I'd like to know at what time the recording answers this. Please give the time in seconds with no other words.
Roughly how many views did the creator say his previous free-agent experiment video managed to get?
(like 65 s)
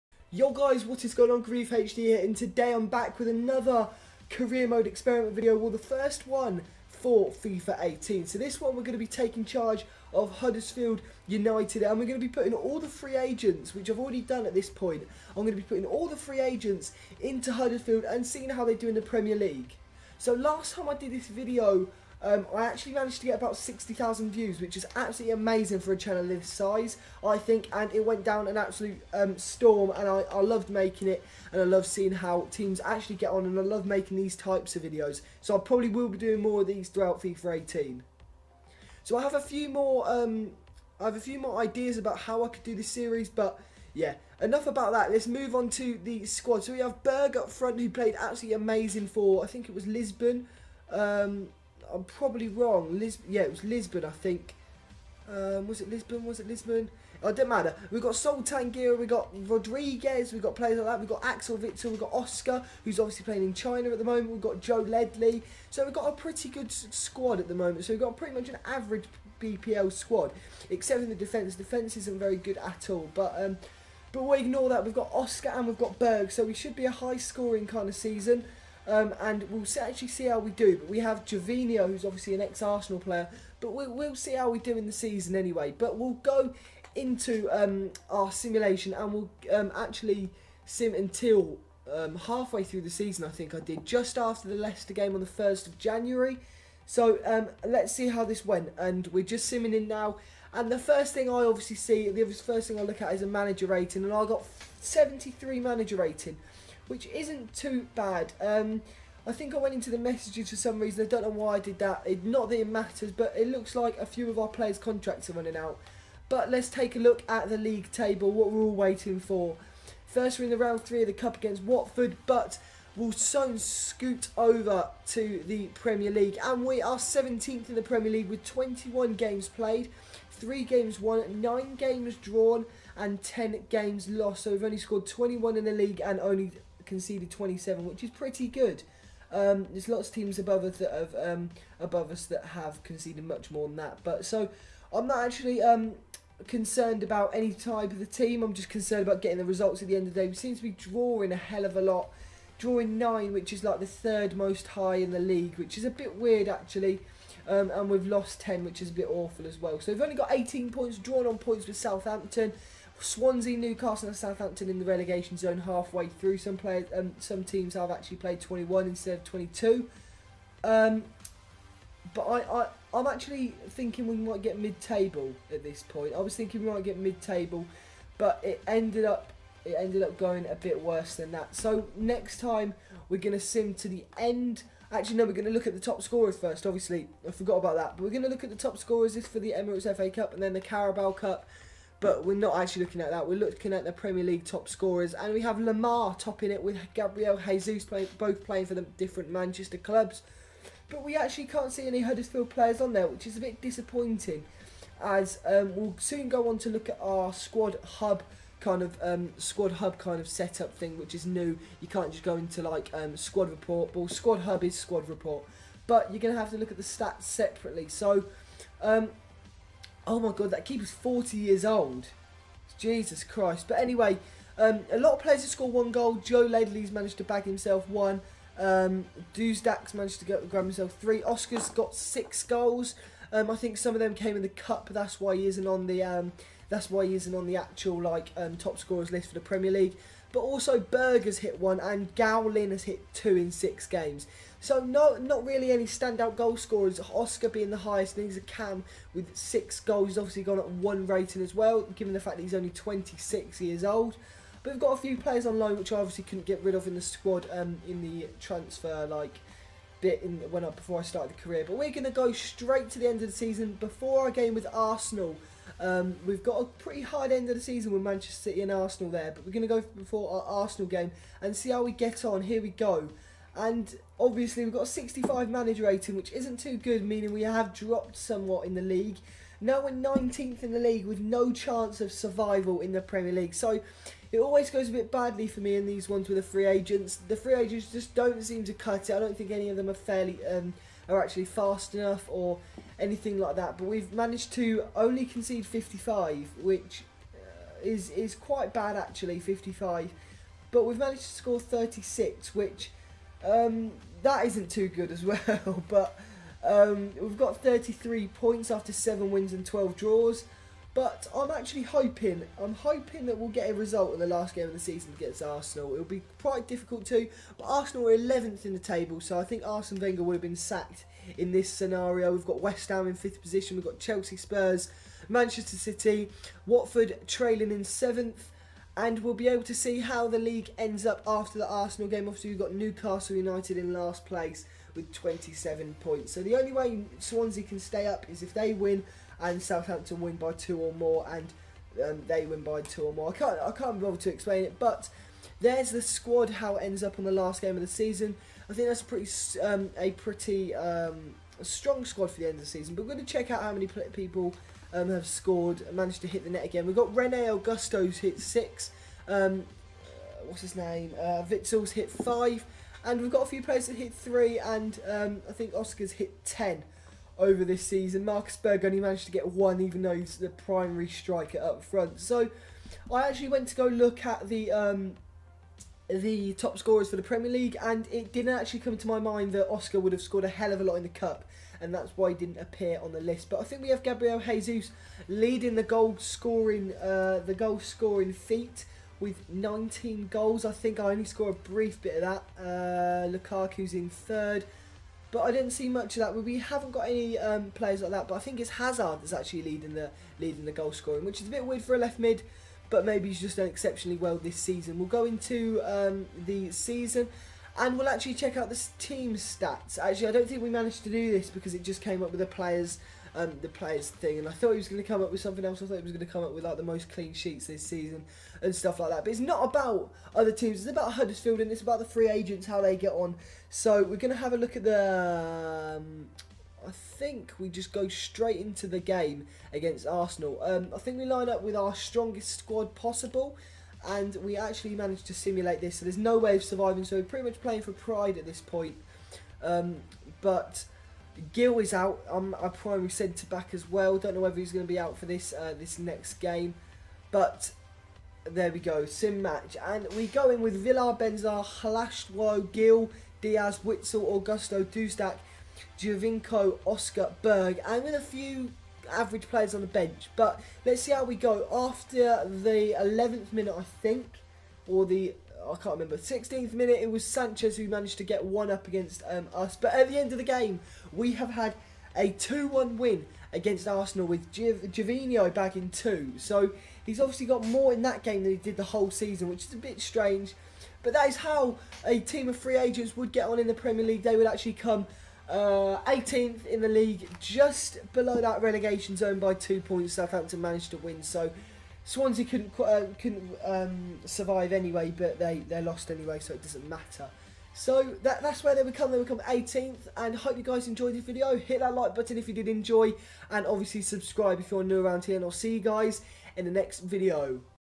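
23 s.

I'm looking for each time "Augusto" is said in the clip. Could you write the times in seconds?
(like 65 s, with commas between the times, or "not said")
357 s, 454 s.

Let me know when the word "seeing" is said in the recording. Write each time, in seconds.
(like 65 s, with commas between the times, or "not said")
18 s, 31 s.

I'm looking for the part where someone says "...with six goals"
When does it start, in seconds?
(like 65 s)
249 s.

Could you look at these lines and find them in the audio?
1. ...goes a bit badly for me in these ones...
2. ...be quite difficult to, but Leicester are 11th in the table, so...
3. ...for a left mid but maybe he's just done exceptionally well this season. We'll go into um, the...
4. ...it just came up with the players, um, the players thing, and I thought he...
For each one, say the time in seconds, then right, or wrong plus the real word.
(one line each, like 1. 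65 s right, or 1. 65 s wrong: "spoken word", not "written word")
1. 284 s right
2. 316 s wrong: "Arsenal", not "Leicester"
3. 401 s right
4. 411 s right.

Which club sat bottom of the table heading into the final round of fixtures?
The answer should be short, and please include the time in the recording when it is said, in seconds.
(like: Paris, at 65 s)
Newcastle United, at 332 s.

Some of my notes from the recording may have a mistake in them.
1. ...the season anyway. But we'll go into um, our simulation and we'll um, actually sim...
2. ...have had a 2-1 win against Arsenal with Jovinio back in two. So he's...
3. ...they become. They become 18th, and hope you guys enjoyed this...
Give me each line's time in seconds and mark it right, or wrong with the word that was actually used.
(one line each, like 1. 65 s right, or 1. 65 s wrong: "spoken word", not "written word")
1. 84 s right
2. 471 s right
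3. 498 s right.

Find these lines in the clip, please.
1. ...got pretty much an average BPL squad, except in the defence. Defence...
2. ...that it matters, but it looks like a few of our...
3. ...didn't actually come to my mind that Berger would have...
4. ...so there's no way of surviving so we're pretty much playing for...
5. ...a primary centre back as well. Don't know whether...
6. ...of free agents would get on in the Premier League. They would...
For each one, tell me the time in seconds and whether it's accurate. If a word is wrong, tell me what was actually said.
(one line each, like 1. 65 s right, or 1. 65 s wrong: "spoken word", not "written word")
1. 67 s right
2. 112 s right
3. 378 s wrong: "Oscar", not "Berger"
4. 435 s right
5. 442 s right
6. 482 s right.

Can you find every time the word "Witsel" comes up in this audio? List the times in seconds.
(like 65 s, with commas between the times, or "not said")
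61 s, 361 s, 453 s.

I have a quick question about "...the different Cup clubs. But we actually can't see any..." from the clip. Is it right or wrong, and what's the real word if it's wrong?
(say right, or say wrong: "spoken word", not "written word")
wrong: "Manchester", not "Cup".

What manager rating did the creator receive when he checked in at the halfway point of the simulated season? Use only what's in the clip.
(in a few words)
73.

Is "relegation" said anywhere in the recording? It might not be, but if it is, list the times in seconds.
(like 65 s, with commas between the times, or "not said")
164 s, 488 s.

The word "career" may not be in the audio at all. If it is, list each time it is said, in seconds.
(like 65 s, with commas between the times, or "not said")
4 s, 261 s.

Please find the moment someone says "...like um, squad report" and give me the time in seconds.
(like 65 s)
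212 s.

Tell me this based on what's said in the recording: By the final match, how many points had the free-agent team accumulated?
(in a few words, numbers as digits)
33.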